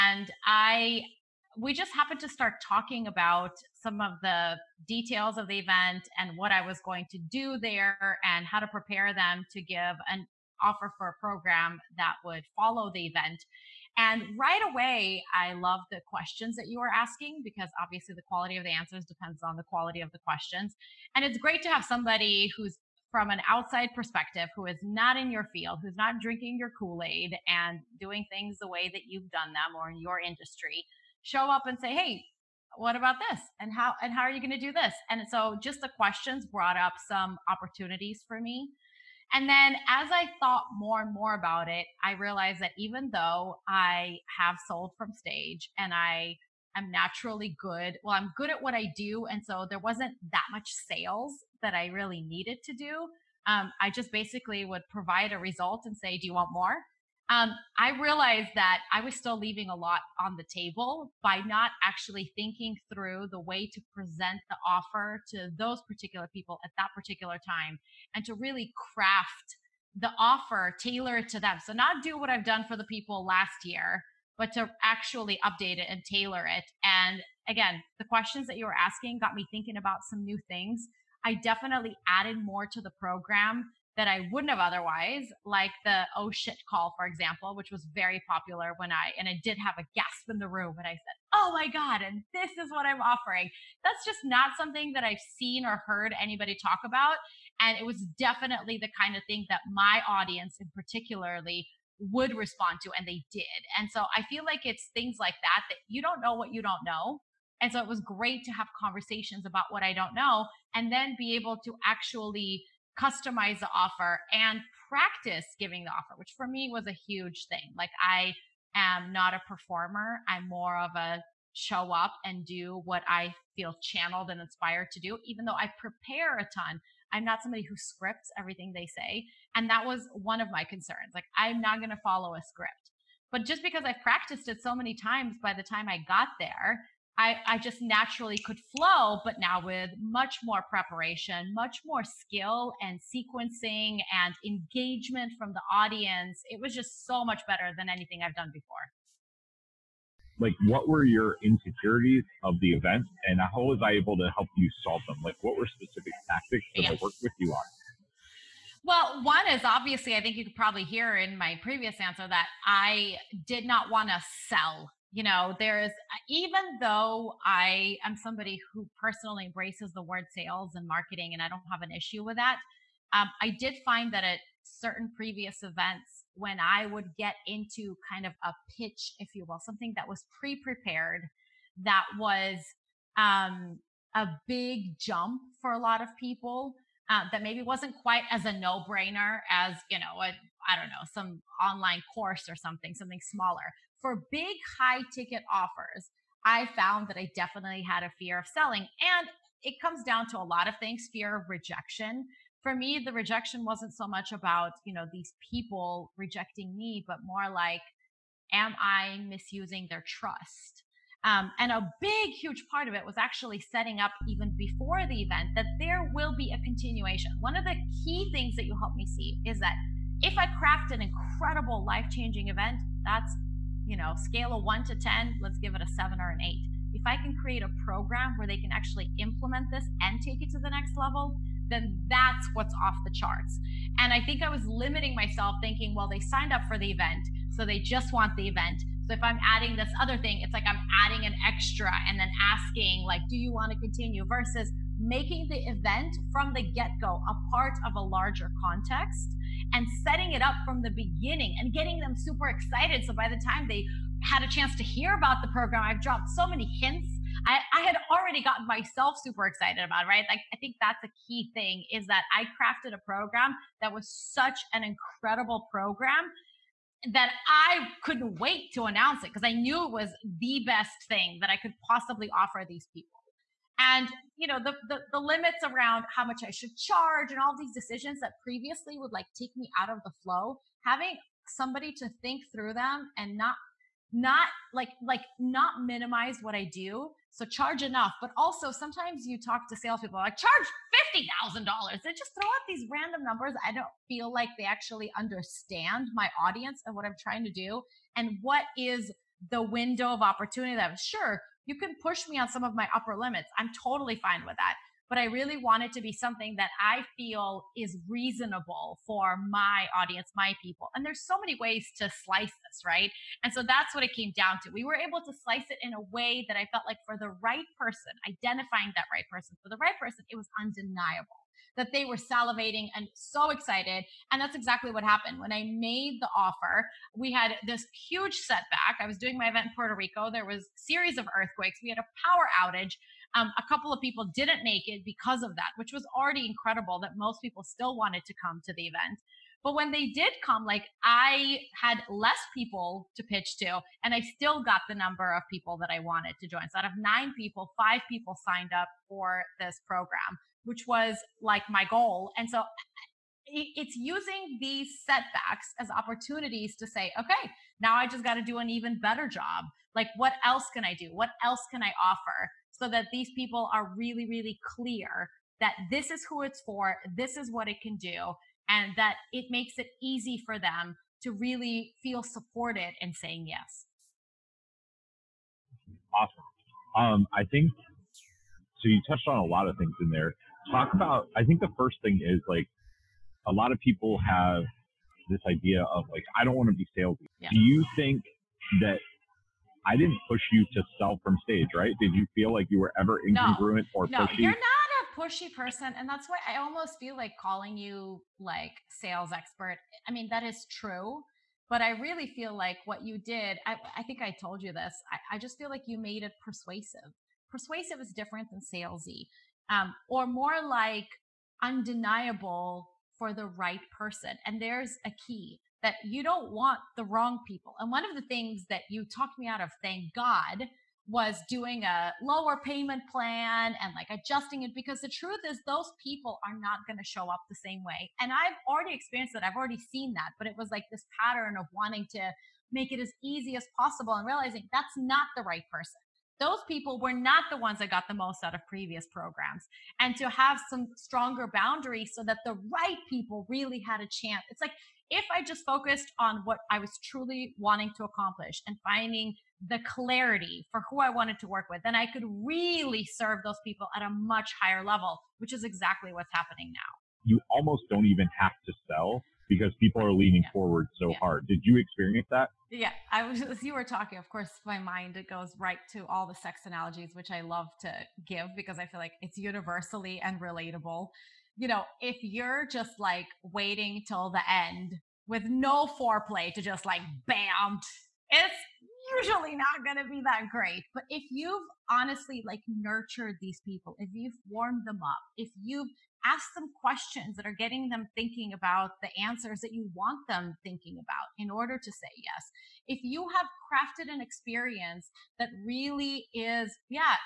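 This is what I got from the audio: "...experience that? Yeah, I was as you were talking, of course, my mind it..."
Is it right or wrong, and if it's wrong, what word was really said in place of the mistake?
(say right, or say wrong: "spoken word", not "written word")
right.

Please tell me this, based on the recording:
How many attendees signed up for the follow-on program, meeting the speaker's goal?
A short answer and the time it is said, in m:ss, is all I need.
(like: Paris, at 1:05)
5, at 5:47.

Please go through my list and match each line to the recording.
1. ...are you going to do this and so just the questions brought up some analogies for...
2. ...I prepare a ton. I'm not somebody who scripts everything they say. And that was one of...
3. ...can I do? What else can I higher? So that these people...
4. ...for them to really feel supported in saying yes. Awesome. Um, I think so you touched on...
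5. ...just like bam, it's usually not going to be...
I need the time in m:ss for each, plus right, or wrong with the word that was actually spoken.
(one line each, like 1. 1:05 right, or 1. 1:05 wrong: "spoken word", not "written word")
1. 0:34 wrong: "opportunities", not "analogies"
2. 2:05 right
3. 6:00 wrong: "offer", not "higher"
4. 6:10 right
5. 7:56 right.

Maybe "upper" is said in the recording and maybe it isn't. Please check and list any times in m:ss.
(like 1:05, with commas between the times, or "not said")
5:02.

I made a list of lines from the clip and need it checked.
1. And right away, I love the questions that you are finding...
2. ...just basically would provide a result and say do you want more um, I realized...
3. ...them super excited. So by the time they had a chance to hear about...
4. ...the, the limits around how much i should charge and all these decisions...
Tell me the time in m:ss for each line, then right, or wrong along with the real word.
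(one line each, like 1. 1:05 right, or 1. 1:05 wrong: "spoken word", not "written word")
1. 0:13 wrong: "asking", not "finding"
2. 0:53 right
3. 4:11 right
4. 4:34 right.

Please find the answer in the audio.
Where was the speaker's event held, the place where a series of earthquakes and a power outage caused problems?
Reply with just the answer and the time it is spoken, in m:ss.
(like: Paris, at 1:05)
Puerto Rico, at 5:29.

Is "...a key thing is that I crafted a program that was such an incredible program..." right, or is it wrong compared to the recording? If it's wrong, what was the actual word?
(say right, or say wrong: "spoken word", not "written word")
right.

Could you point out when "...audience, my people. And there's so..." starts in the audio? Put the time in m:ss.
5:09.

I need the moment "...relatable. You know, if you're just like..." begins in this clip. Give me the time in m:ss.
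7:50.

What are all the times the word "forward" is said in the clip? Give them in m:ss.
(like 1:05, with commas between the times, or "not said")
7:40.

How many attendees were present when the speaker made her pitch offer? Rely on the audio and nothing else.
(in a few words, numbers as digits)
9.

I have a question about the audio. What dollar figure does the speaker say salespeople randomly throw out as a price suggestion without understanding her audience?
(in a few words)
$50,000.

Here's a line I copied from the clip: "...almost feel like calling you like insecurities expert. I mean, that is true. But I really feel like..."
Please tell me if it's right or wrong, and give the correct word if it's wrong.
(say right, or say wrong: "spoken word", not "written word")
wrong: "sales", not "insecurities".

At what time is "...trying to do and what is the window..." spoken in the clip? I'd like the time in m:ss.
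4:57.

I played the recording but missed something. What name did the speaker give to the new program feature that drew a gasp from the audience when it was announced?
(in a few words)
the oh shit call.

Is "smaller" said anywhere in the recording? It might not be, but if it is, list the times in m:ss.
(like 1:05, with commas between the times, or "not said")
3:13.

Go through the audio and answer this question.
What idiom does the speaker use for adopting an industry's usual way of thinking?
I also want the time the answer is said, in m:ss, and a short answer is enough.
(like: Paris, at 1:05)
drinking your Kool Aid, at 0:26.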